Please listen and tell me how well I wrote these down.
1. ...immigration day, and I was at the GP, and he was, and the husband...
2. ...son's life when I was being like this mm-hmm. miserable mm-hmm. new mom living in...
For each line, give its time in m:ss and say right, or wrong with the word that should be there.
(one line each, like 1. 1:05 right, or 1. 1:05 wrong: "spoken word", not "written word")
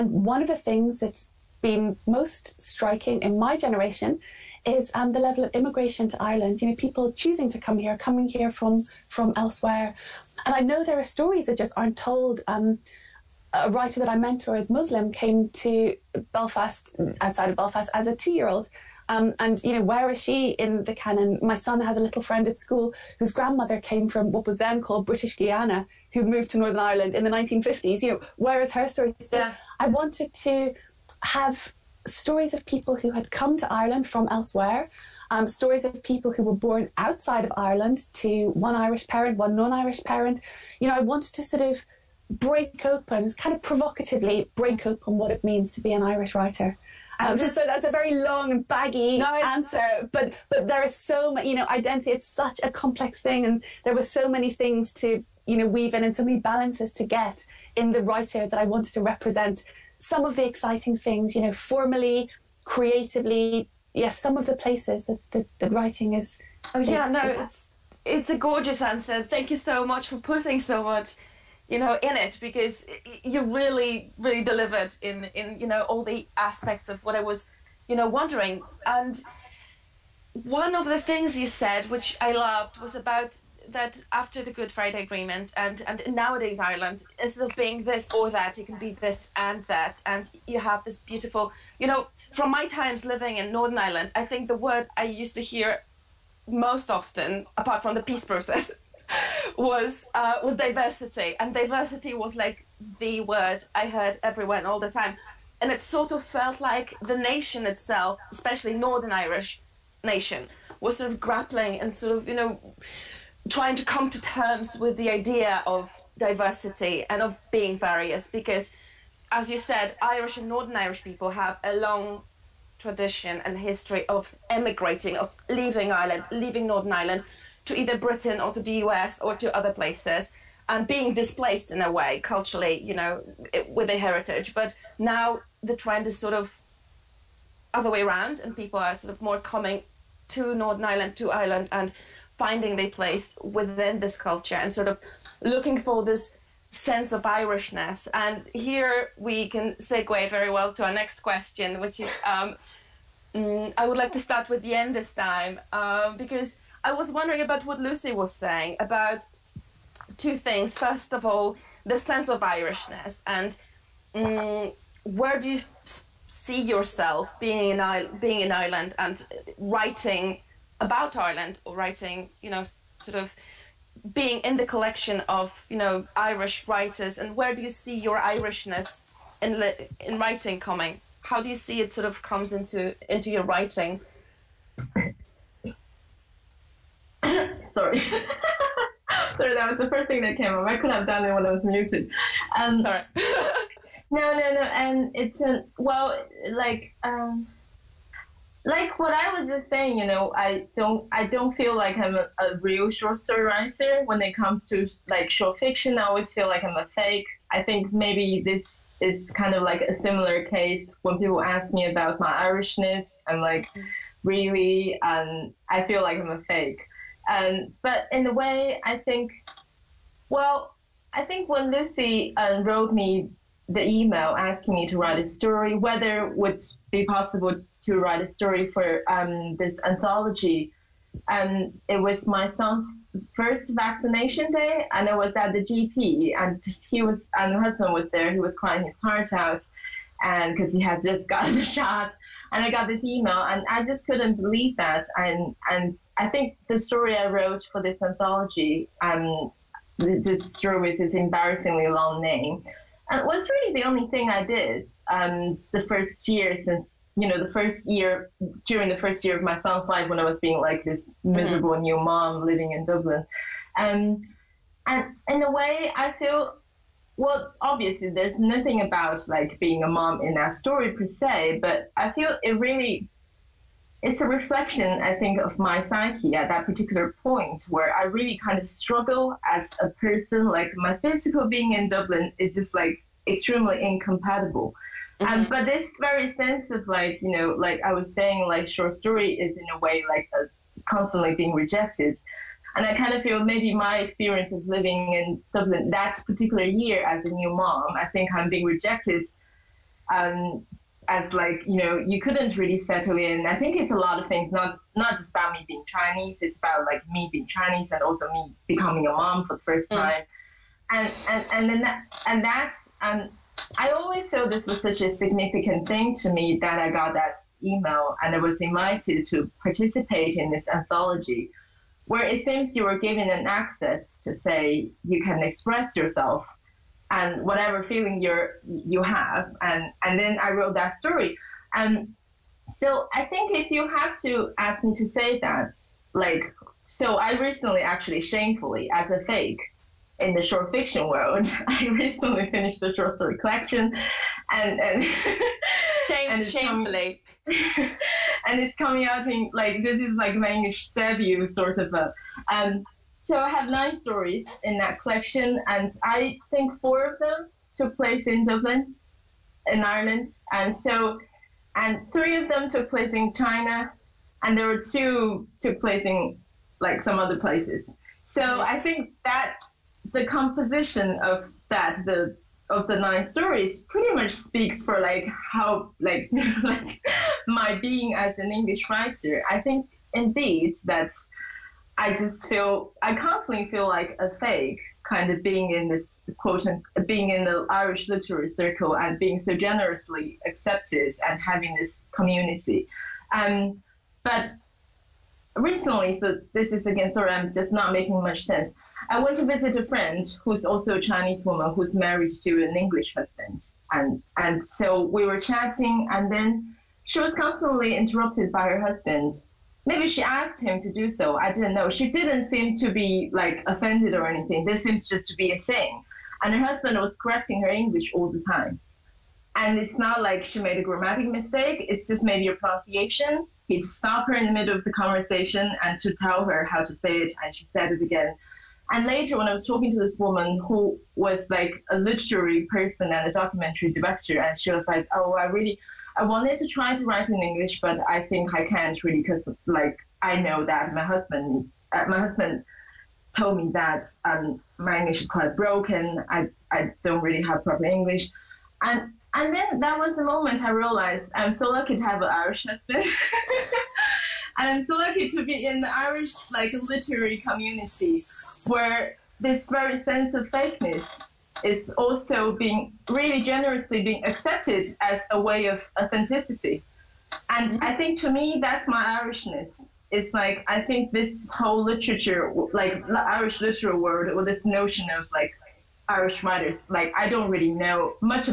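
1. 3:53 wrong: "vaccination", not "immigration"
2. 4:19 right.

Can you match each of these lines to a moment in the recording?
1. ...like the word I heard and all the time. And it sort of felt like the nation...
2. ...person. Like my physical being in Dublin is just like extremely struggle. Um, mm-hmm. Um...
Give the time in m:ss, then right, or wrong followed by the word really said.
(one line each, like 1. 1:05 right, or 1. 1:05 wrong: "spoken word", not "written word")
1. 1:42 right
2. 4:39 wrong: "incompatible", not "struggle".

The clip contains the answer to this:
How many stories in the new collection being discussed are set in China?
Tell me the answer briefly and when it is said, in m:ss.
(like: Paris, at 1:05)
3, at 6:02.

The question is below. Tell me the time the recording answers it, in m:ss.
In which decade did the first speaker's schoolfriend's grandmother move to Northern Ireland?
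0:27.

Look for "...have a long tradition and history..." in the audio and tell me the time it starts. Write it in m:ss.
2:01.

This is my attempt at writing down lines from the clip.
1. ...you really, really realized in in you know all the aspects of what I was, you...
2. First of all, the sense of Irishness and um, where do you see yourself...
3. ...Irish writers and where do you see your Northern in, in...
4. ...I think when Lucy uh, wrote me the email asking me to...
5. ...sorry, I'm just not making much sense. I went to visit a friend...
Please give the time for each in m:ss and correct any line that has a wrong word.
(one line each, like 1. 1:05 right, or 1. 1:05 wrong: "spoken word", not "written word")
1. 1:13 wrong: "delivered", not "realized"
2. 2:40 right
3. 2:56 wrong: "Irishness", not "Northern"
4. 3:41 right
5. 6:37 right.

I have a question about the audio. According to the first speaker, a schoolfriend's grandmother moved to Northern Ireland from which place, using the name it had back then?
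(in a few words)
British Guiana.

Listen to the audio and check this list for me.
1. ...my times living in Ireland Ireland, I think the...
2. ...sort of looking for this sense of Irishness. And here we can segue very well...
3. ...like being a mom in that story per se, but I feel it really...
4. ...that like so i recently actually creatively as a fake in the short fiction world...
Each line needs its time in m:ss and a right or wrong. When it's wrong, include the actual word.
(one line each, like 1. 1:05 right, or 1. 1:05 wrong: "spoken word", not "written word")
1. 1:32 wrong: "Northern", not "Ireland"
2. 2:24 right
3. 4:29 right
4. 5:35 wrong: "shamefully", not "creatively".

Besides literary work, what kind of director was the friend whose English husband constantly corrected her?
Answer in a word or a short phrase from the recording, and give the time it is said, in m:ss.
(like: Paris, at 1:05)
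documentary director, at 7:13.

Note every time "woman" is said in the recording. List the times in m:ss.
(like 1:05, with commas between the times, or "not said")
6:41, 7:10.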